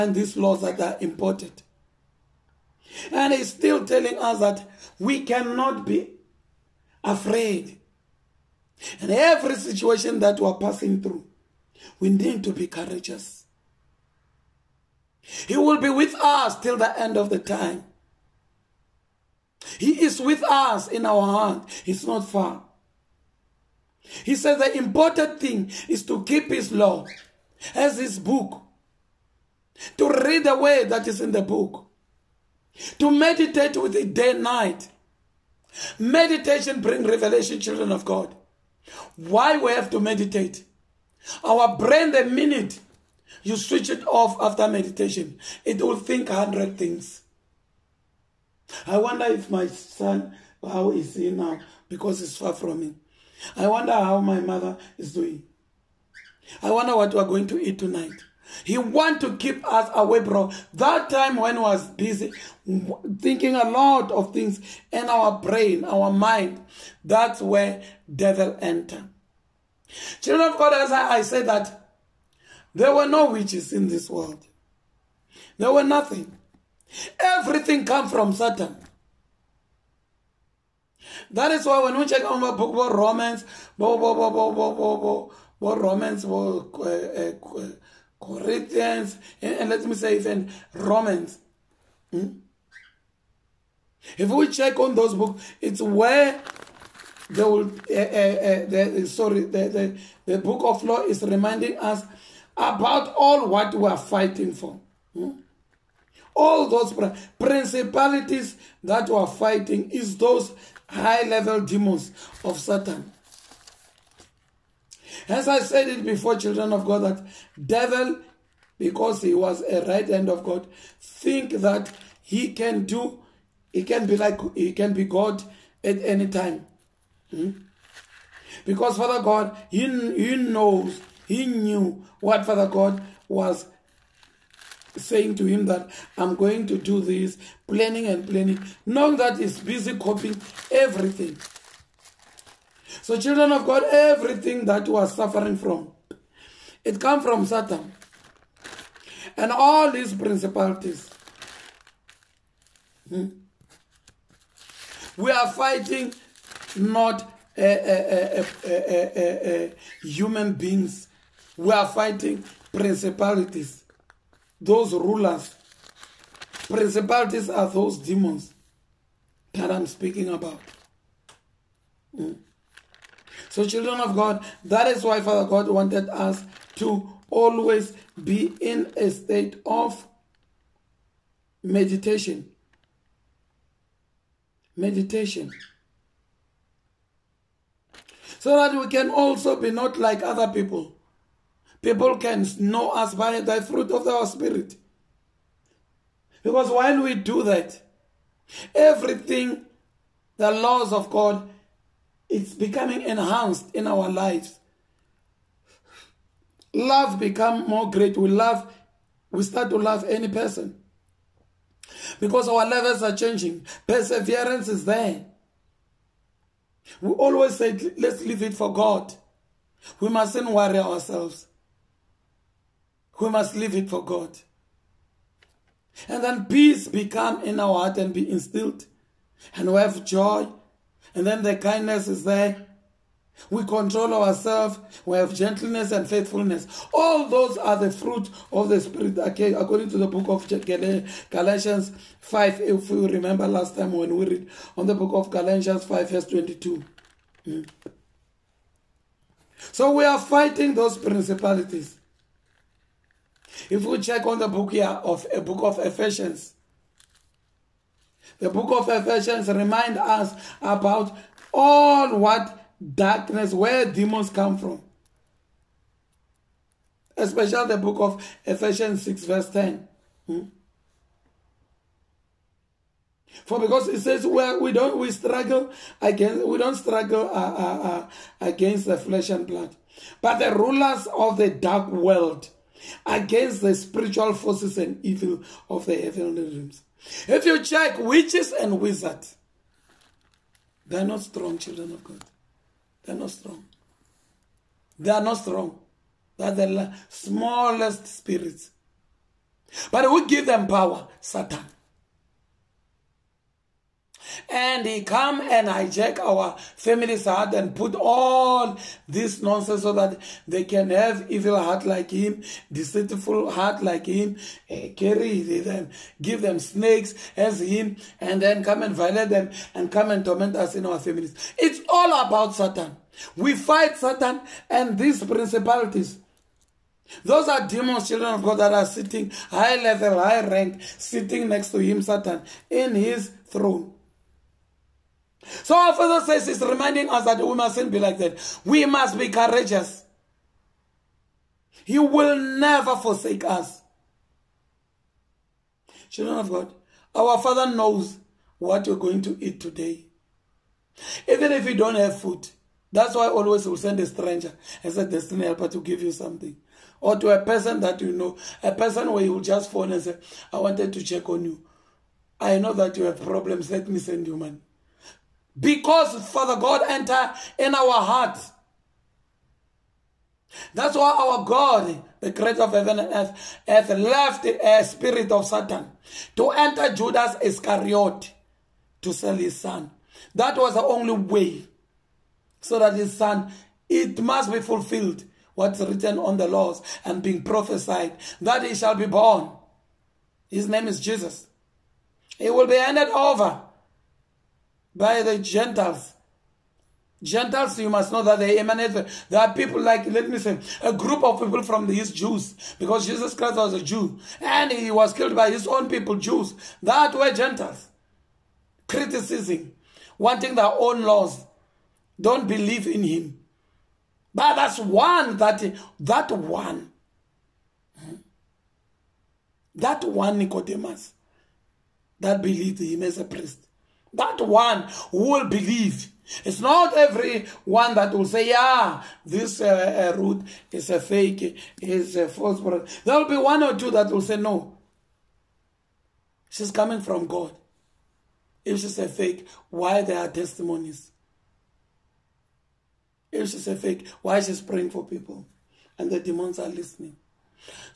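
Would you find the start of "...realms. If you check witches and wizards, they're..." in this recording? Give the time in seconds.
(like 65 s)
286 s.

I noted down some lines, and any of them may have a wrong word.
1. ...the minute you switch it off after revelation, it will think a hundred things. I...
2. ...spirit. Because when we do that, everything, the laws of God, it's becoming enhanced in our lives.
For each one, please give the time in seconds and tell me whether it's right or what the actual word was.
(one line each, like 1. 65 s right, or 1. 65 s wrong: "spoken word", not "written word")
1. 42 s wrong: "meditation", not "revelation"
2. 194 s right.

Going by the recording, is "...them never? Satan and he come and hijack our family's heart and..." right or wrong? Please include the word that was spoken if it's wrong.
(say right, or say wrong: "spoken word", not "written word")
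wrong: "power", not "never".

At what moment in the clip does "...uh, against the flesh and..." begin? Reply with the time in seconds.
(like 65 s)
277 s.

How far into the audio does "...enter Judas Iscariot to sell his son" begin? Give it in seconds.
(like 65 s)
376 s.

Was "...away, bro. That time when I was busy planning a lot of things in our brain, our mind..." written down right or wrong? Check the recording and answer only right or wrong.
wrong.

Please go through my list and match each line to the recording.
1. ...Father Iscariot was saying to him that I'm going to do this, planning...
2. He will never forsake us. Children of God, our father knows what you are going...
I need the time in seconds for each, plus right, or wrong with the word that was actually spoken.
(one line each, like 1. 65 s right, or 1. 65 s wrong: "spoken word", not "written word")
1. 132 s wrong: "God", not "Iscariot"
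2. 341 s right.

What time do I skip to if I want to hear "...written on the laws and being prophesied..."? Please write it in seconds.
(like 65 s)
385 s.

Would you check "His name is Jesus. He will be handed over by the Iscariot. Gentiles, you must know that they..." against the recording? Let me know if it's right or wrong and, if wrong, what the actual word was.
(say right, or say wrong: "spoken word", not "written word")
wrong: "Gentiles", not "Iscariot".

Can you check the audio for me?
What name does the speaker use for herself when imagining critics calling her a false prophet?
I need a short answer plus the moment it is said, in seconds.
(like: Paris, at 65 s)
Ruth, at 430 s.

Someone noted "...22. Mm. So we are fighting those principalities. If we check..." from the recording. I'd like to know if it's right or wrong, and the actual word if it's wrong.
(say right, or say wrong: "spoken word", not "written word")
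right.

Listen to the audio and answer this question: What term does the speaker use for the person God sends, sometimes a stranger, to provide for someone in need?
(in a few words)
destiny helper.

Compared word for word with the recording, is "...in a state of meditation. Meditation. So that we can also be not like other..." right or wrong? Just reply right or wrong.
right.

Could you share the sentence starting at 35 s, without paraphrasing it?
Meditation brings revelation, children of God.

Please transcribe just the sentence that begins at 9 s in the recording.
In every situation that we're passing through, we need to be courageous.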